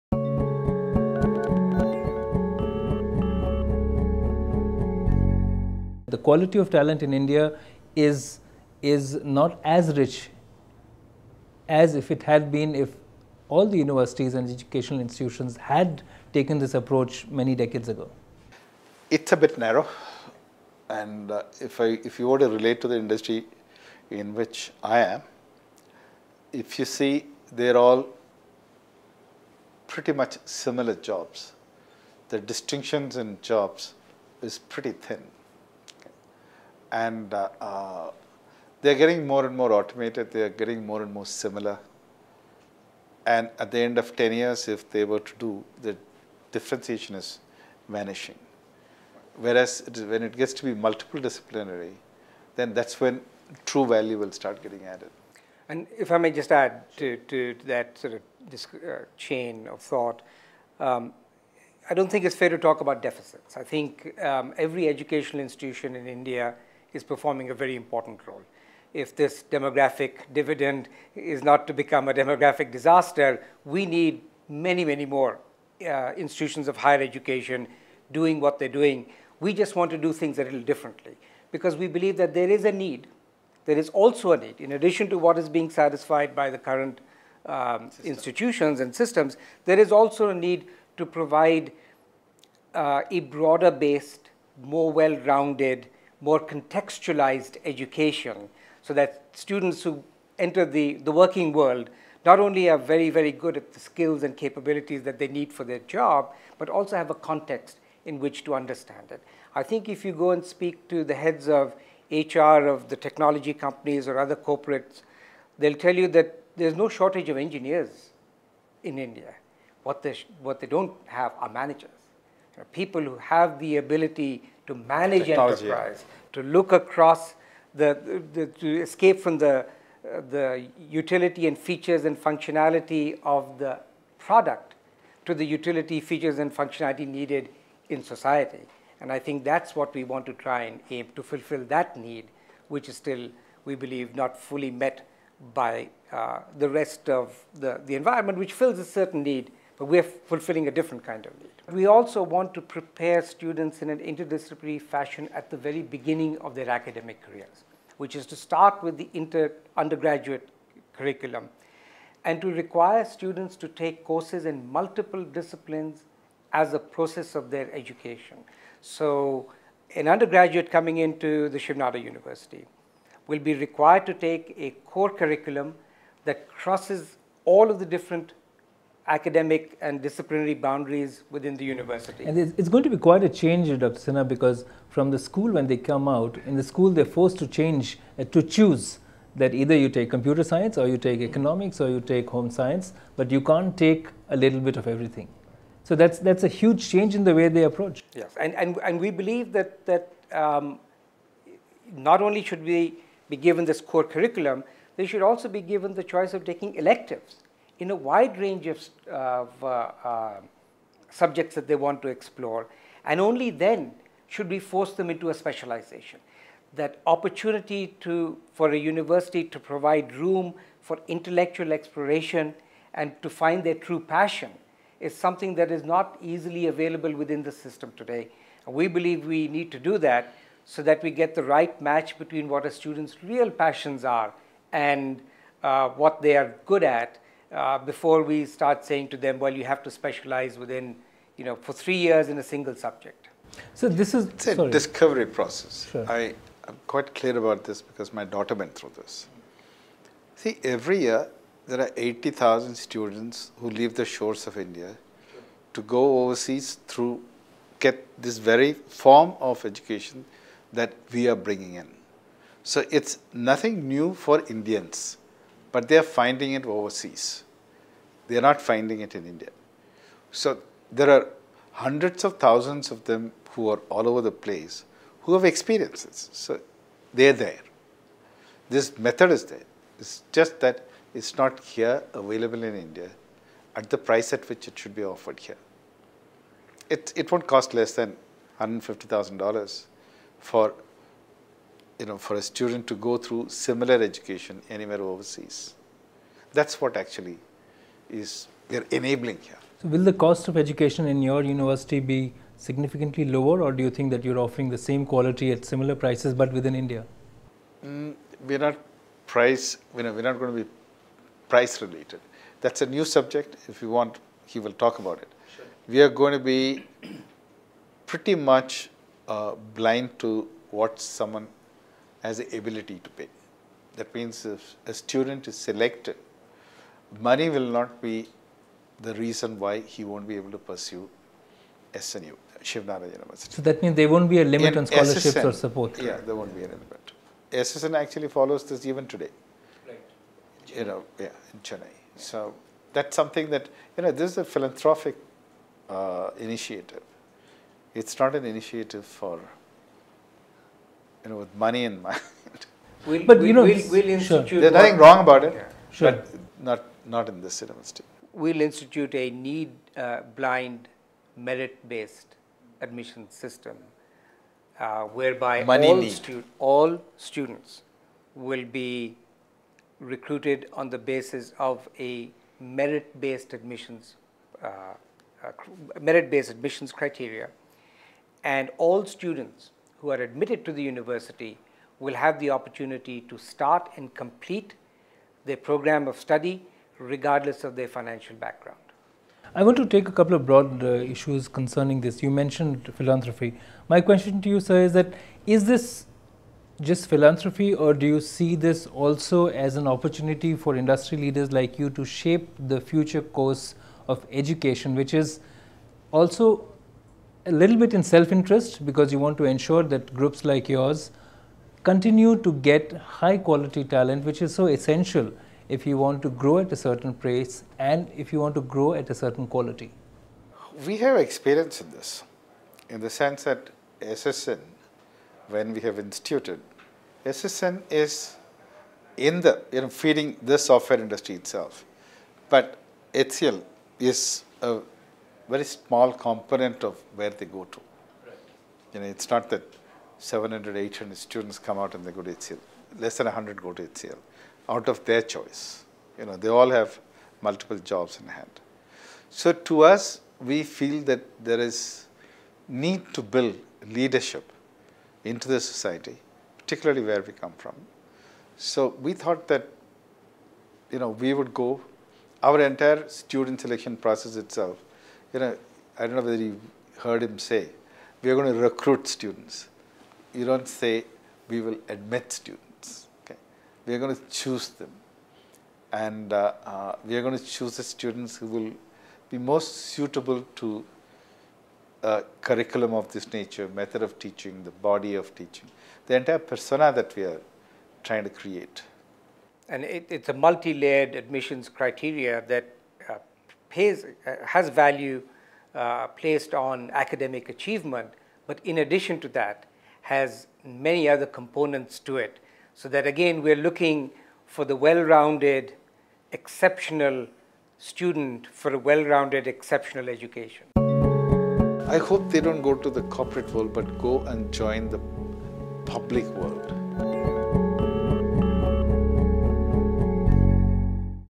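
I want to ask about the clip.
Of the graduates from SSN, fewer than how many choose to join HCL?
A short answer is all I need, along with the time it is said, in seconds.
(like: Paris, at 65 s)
100, at 443 s.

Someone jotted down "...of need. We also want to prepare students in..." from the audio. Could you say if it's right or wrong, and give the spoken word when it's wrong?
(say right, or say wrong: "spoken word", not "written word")
right.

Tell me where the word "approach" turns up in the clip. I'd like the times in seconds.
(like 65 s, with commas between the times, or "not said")
16 s, 197 s.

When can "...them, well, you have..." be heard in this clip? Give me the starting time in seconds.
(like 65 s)
239 s.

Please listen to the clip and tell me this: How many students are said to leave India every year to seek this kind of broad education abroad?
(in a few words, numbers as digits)
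80,000.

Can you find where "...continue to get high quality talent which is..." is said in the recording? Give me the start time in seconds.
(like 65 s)
411 s.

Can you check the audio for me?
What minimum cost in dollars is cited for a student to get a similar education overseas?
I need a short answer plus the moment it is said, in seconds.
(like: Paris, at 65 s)
$150,000, at 288 s.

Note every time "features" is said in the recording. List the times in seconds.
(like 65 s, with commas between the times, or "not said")
131 s, 136 s.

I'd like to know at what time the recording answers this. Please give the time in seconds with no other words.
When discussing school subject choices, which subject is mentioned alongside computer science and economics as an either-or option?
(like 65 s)
192 s.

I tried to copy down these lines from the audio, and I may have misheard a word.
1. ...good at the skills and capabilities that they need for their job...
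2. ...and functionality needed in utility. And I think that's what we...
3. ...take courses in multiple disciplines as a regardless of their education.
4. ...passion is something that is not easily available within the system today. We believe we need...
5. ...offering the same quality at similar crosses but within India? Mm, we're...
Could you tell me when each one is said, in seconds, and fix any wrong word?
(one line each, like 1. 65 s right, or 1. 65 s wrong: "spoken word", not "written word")
1. 103 s right
2. 136 s wrong: "society", not "utility"
3. 163 s wrong: "process", not "regardless"
4. 223 s right
5. 304 s wrong: "prices", not "crosses".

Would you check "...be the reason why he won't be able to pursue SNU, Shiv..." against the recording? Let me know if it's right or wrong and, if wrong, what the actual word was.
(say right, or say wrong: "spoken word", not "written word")
right.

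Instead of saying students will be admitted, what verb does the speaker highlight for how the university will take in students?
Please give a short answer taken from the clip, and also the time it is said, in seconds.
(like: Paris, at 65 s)
Recruit, at 468 s.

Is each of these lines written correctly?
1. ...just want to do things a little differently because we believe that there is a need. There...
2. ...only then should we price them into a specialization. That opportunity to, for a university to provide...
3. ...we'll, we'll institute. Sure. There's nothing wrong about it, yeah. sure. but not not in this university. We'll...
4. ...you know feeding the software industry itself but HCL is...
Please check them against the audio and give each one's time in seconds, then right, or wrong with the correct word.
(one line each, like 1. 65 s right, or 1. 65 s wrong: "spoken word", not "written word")
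1. 79 s right
2. 213 s wrong: "force", not "price"
3. 353 s right
4. 429 s right.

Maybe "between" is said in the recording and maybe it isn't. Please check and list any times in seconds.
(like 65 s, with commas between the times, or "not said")
232 s.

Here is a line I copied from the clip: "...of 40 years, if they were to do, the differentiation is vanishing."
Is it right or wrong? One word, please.
wrong.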